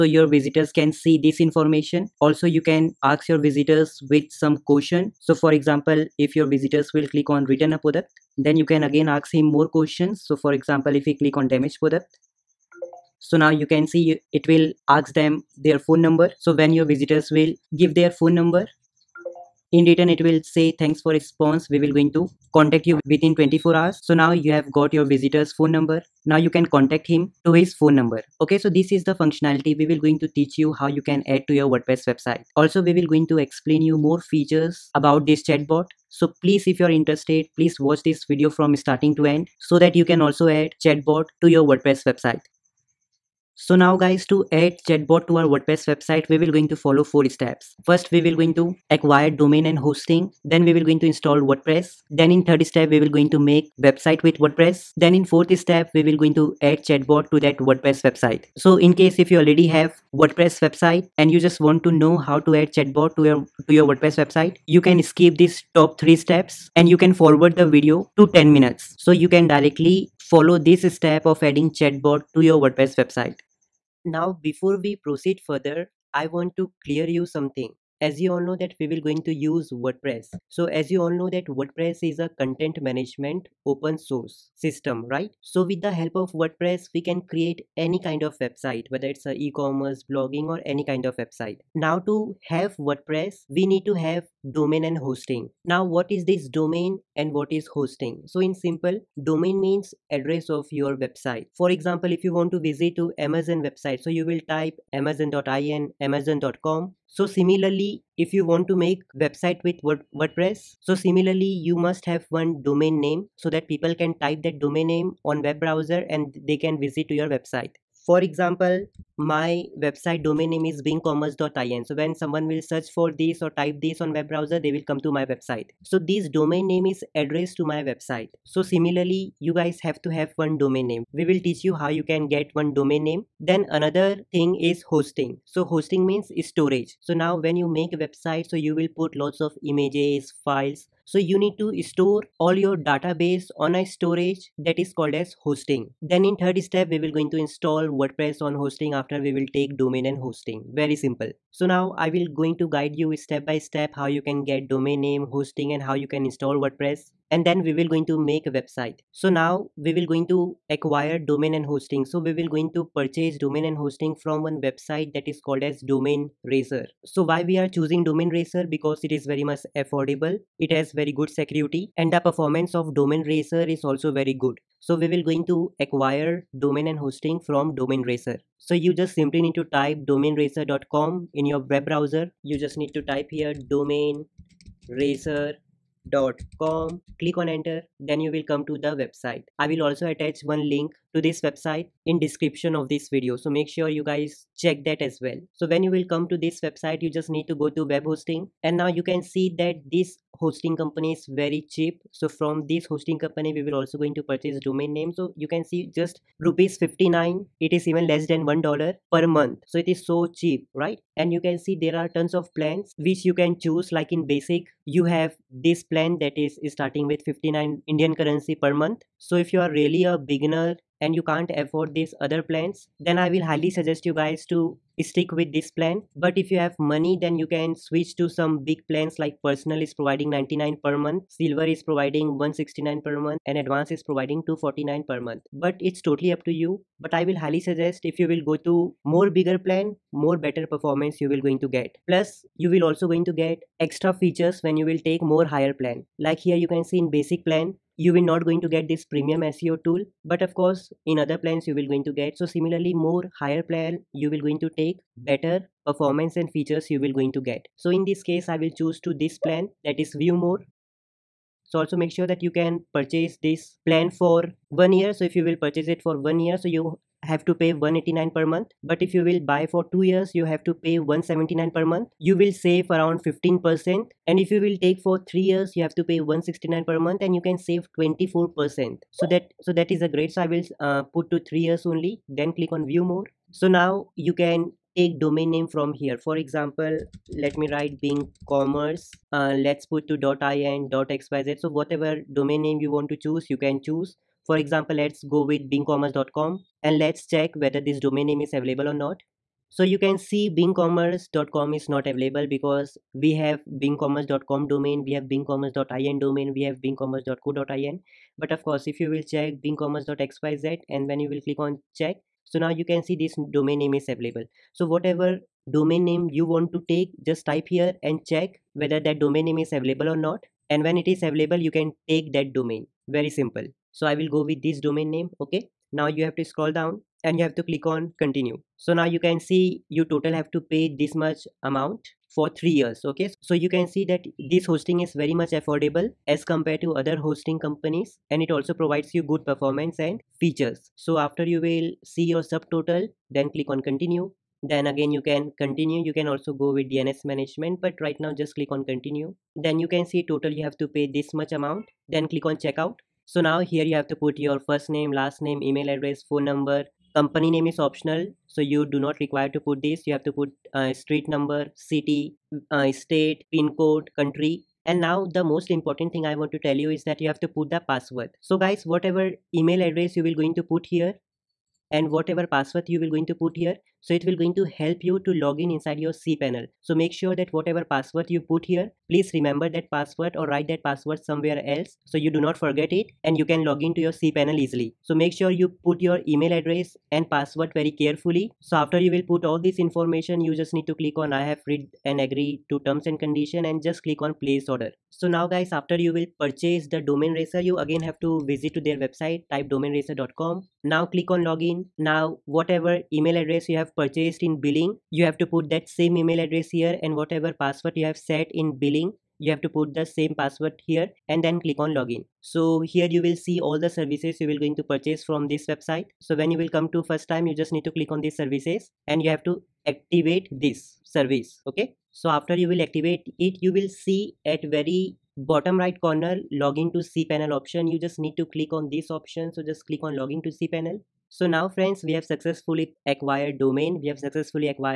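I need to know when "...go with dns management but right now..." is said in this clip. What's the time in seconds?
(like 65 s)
346 s.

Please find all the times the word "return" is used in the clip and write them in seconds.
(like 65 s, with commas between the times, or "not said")
7 s, 19 s.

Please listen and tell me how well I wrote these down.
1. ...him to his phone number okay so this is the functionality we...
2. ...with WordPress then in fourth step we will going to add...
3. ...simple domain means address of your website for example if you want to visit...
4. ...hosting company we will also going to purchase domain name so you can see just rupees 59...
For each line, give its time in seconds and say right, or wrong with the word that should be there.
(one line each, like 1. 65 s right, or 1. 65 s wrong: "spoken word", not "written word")
1. 27 s right
2. 54 s right
3. 98 s right
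4. 202 s right.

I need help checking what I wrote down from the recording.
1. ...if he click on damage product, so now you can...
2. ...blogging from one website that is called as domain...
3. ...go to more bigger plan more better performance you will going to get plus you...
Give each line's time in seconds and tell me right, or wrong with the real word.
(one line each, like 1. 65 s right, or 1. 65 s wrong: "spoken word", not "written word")
1. 10 s right
2. 163 s wrong: "hosting", not "blogging"
3. 238 s right.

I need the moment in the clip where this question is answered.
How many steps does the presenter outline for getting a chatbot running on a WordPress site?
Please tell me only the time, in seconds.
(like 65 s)
47 s.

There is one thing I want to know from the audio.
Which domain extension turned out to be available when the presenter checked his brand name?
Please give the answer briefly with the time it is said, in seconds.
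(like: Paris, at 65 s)
.xyz, at 309 s.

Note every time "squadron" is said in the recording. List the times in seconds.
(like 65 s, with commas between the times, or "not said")
not said.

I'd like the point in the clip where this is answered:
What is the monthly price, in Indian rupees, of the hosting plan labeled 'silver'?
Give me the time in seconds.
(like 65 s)
231 s.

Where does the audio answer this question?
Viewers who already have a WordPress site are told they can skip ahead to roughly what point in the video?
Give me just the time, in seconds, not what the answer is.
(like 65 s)
68 s.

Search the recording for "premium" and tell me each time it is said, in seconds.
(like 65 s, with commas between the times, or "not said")
249 s.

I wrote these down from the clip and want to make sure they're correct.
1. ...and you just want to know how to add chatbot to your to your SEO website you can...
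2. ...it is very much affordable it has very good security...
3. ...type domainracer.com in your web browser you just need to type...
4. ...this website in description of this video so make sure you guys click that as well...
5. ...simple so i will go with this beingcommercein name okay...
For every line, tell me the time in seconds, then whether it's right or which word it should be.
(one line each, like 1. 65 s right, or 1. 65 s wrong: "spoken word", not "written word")
1. 61 s wrong: "WordPress", not "SEO"
2. 169 s right
3. 179 s right
4. 191 s wrong: "check", not "click"
5. 323 s wrong: "domain", not "beingcommercein".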